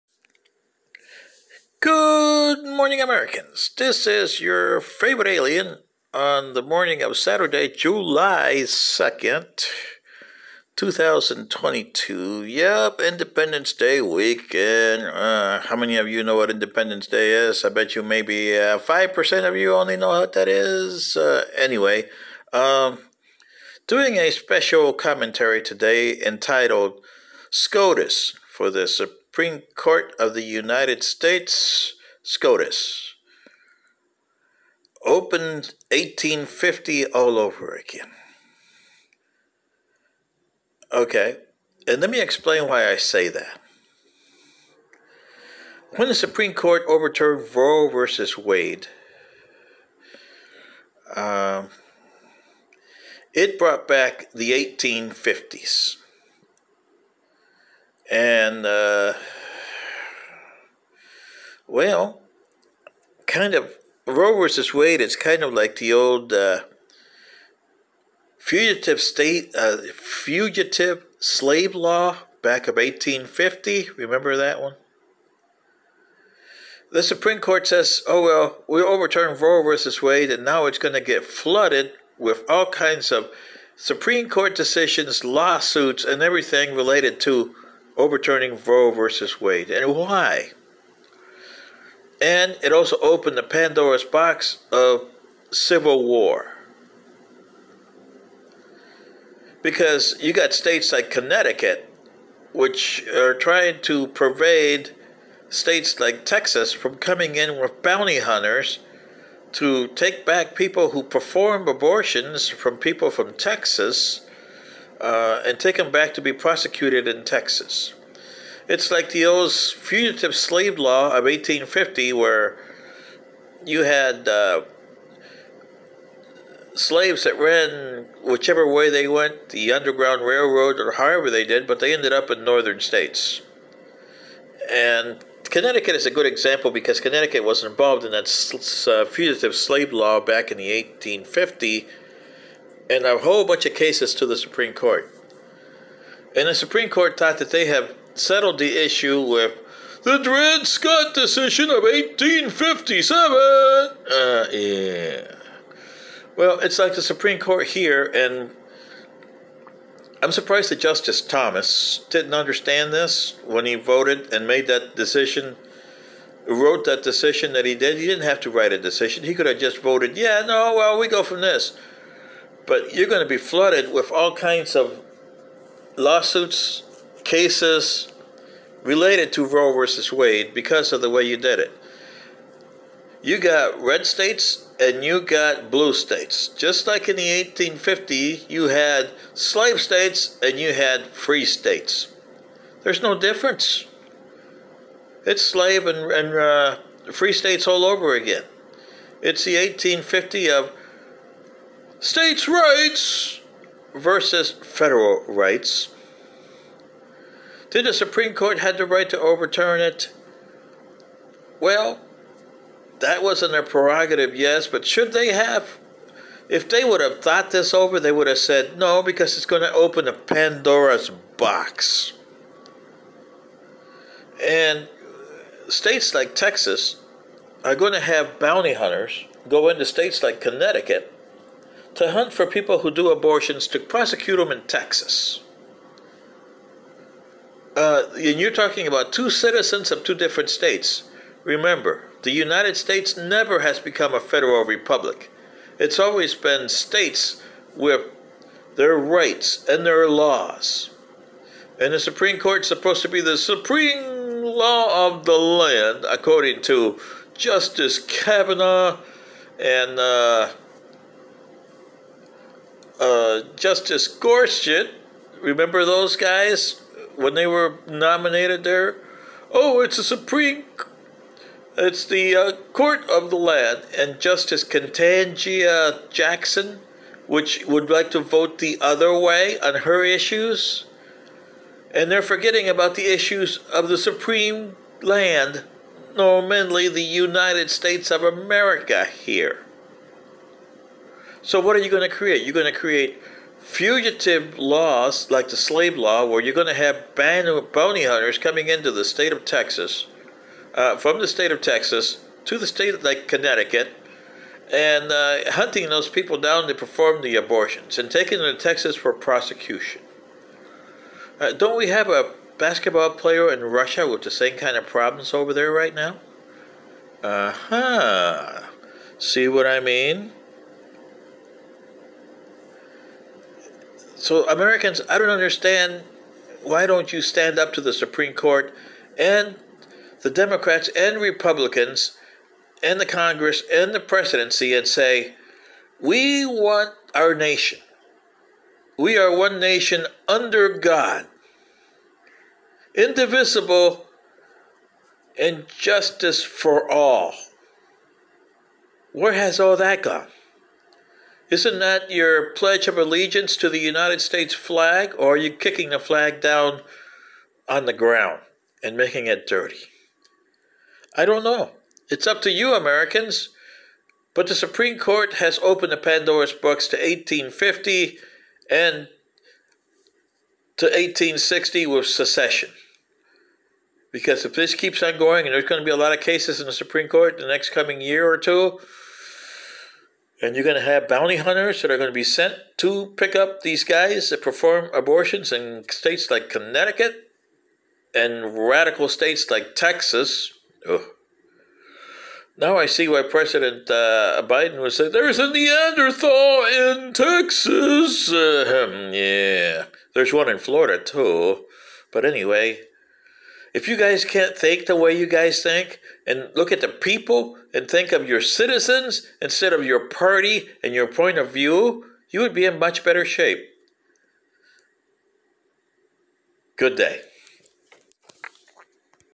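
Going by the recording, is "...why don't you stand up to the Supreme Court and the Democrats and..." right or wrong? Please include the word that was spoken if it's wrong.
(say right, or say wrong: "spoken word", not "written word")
right.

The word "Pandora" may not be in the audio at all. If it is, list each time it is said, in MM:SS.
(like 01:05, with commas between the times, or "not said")
01:33, 03:40, 06:05.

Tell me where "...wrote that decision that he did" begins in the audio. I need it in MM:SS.
02:46.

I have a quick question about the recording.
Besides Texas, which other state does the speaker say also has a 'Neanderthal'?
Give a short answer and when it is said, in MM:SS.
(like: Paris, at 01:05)
Florida, at 06:40.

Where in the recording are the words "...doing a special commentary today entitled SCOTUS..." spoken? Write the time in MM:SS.
00:23.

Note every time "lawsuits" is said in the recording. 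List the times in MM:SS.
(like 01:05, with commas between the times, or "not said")
01:25, 02:55.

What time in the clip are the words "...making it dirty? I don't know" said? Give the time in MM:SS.
05:58.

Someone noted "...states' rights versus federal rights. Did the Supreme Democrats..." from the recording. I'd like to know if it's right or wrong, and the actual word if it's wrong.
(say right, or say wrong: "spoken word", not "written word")
wrong: "Court", not "Democrats".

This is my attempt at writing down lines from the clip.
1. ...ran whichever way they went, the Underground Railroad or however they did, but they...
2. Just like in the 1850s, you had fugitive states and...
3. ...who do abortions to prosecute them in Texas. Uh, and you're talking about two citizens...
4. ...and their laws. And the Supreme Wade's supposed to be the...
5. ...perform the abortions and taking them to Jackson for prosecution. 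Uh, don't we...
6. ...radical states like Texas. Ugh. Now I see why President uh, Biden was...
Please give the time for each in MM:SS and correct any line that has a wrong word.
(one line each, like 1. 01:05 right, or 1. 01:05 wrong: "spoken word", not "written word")
1. 02:07 right
2. 03:06 wrong: "slave", not "fugitive"
3. 03:52 right
4. 04:09 wrong: "Court", not "Wade"
5. 05:06 wrong: "Texas", not "Jackson"
6. 06:28 right.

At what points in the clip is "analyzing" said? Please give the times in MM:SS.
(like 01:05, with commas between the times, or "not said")
not said.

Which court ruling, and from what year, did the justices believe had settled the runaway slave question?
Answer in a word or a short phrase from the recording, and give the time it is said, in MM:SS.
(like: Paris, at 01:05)
Dred Scott, 1857, at 02:30.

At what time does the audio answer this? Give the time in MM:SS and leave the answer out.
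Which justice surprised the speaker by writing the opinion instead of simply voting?
02:40.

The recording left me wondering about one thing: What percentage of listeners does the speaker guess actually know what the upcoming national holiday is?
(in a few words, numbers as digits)
5%.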